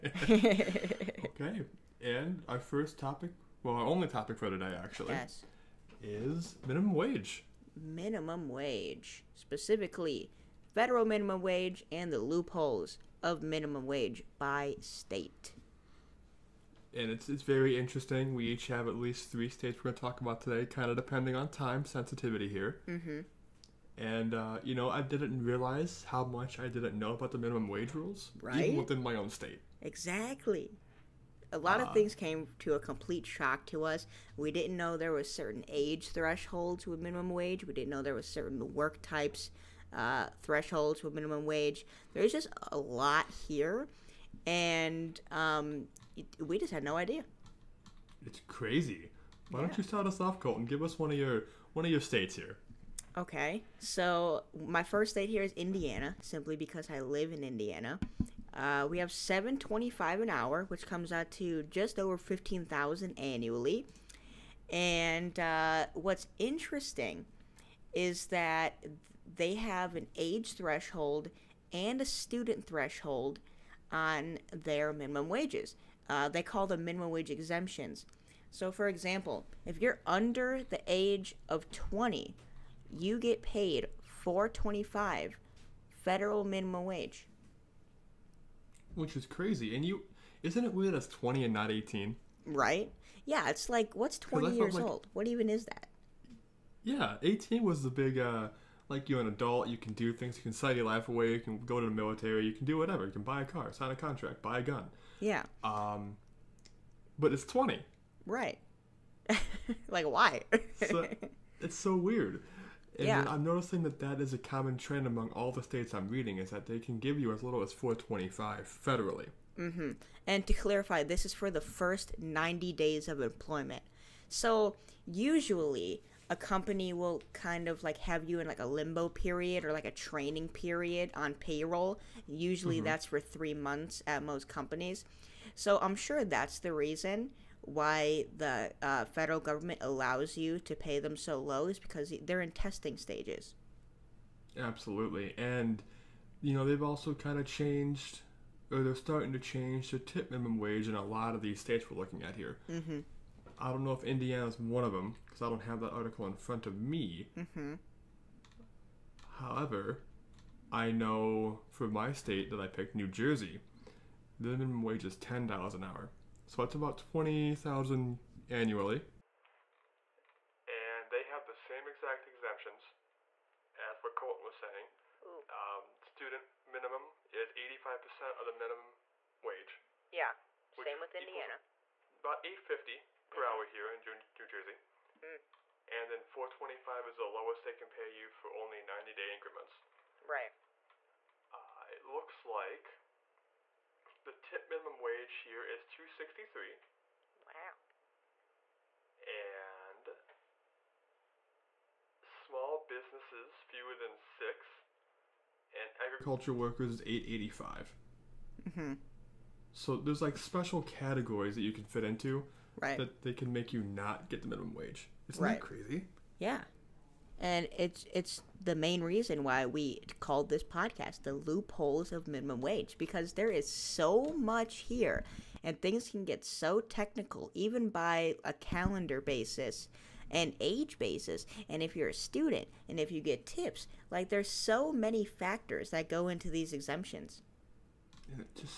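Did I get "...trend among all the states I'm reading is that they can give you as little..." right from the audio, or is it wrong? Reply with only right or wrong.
right.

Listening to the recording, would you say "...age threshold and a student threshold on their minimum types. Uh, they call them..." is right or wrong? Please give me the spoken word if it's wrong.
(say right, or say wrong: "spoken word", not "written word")
wrong: "wages", not "types".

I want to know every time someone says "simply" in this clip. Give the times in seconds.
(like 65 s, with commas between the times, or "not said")
56 s.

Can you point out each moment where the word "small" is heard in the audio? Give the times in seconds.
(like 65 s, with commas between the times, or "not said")
202 s.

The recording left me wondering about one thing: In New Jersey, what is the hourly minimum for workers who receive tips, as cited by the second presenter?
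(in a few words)
2.63.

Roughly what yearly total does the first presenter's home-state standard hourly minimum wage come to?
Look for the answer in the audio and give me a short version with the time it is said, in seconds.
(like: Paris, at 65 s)
just over 15,000, at 61 s.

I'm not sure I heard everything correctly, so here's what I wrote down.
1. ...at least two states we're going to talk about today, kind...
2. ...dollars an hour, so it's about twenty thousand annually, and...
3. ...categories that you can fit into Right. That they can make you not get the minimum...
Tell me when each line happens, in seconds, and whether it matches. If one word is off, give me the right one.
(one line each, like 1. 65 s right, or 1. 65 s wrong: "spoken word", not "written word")
1. 18 s wrong: "three", not "two"
2. 165 s right
3. 210 s right.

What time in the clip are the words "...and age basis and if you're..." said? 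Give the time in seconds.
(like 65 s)
230 s.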